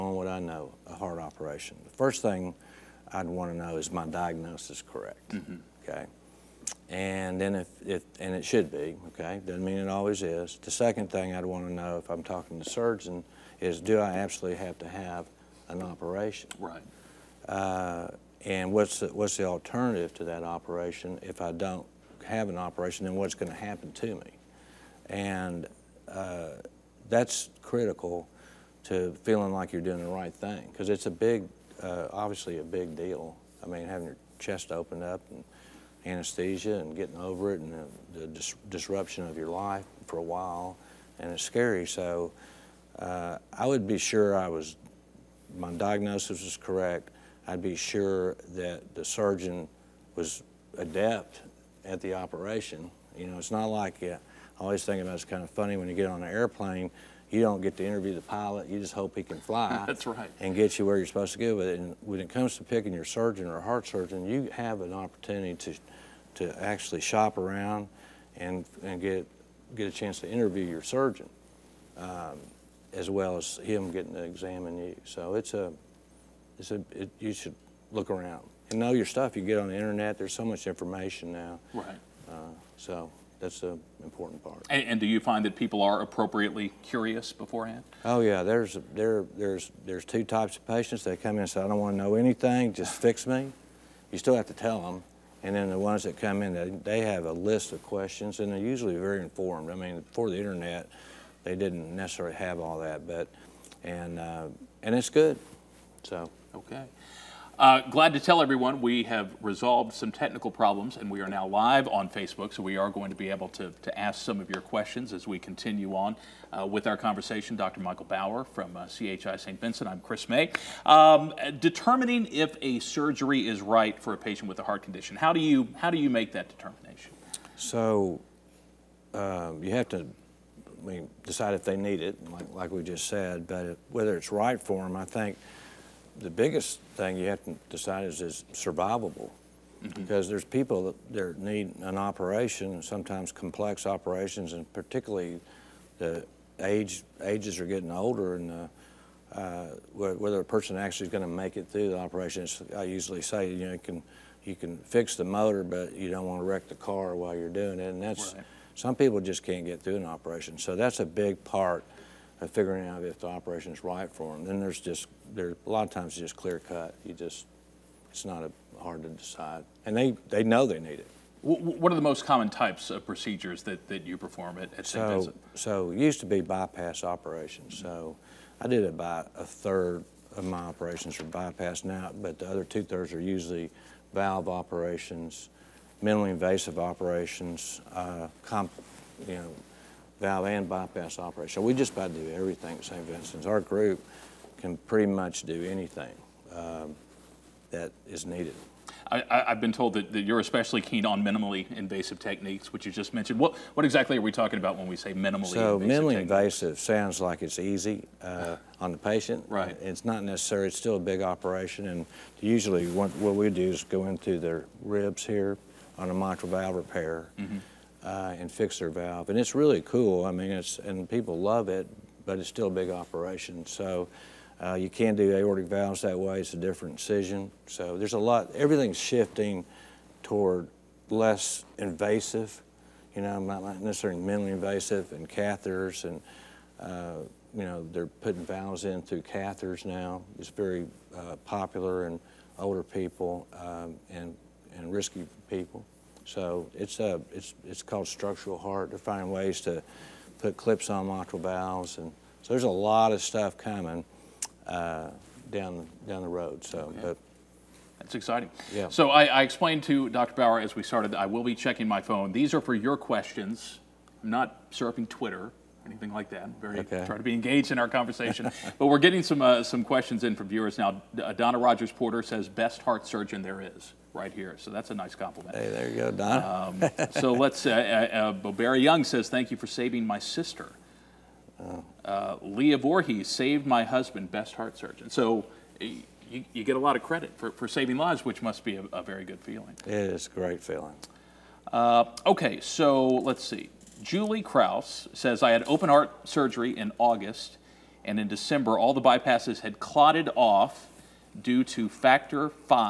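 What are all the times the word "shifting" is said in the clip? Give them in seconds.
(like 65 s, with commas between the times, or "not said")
229 s.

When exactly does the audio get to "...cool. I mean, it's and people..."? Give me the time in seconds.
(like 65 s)
219 s.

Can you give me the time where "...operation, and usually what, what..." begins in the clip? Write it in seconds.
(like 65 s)
211 s.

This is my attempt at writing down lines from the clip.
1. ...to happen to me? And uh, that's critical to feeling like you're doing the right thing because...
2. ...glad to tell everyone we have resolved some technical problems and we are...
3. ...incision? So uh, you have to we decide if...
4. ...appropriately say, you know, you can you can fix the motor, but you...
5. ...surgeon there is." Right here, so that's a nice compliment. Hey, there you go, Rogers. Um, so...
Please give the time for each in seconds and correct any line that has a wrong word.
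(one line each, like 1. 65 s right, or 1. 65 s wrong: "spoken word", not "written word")
1. 23 s right
2. 107 s right
3. 126 s wrong: "determination", not "incision"
4. 152 s wrong: "usually", not "appropriately"
5. 273 s wrong: "Donna", not "Rogers".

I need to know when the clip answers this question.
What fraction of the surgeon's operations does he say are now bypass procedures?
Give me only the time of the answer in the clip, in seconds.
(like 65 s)
179 s.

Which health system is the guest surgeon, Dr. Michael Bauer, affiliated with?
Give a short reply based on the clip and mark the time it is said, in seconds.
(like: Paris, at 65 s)
CHI St. Vincent, at 118 s.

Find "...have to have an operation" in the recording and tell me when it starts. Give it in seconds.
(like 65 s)
14 s.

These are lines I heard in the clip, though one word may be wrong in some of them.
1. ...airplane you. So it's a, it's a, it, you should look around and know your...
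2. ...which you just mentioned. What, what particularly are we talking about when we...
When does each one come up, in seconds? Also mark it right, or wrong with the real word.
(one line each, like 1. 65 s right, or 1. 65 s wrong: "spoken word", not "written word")
1. 74 s wrong: "examine", not "airplane"
2. 202 s wrong: "exactly", not "particularly".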